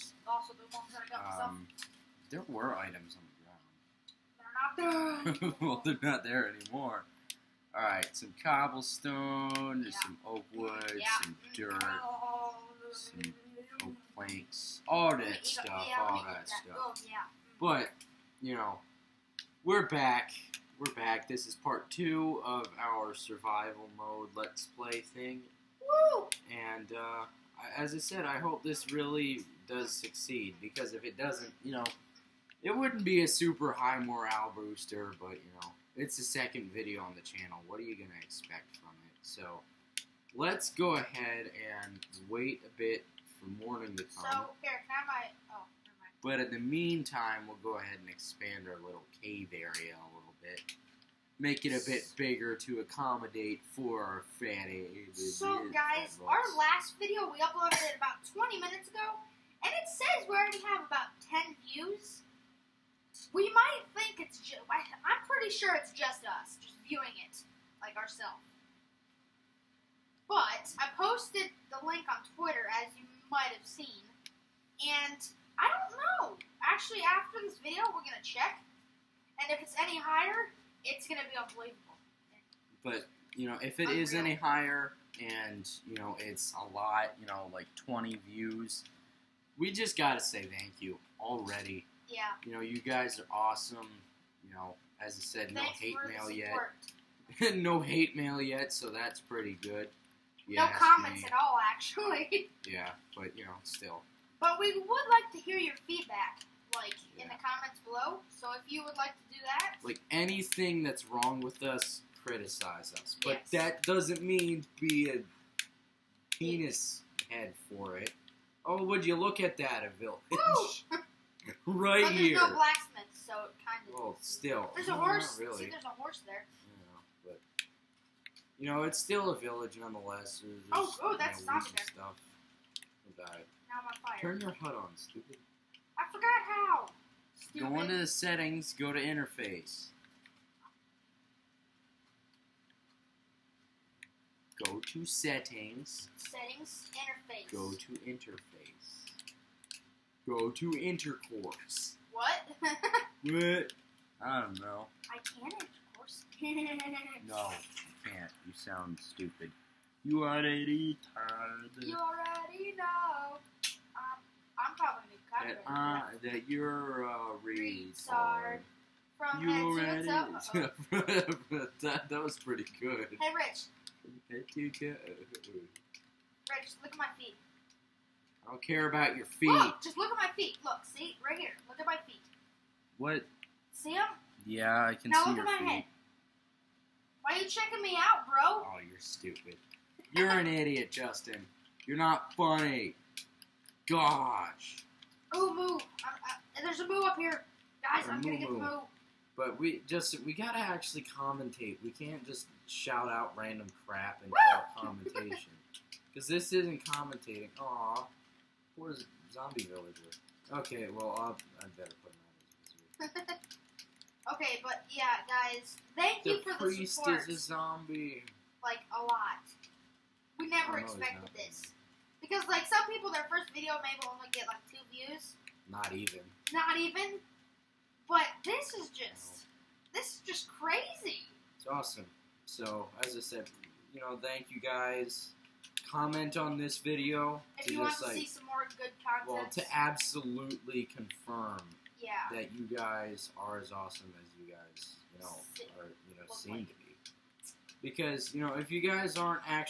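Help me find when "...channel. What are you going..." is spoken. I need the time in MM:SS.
00:37.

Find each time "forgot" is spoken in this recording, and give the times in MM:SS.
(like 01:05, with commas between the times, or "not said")
02:16.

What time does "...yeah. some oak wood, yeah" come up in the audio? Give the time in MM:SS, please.
00:09.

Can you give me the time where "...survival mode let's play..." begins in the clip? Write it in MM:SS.
00:23.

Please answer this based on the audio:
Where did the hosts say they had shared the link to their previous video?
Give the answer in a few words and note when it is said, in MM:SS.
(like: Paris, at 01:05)
Twitter, at 01:12.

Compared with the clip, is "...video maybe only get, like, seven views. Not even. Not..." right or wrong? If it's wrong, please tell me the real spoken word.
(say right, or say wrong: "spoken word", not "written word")
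wrong: "two", not "seven".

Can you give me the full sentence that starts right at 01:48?
So if you would like to do that, like anything that's wrong with us, criticize us.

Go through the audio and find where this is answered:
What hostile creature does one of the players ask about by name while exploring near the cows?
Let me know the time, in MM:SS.
03:29.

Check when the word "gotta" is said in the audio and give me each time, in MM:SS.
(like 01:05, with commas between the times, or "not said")
01:29, 03:20.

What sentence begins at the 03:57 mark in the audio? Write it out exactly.
If you want to like, see some more good content.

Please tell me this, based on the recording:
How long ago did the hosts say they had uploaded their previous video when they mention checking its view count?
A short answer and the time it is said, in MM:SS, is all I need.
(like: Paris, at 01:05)
About 20 minutes, at 00:57.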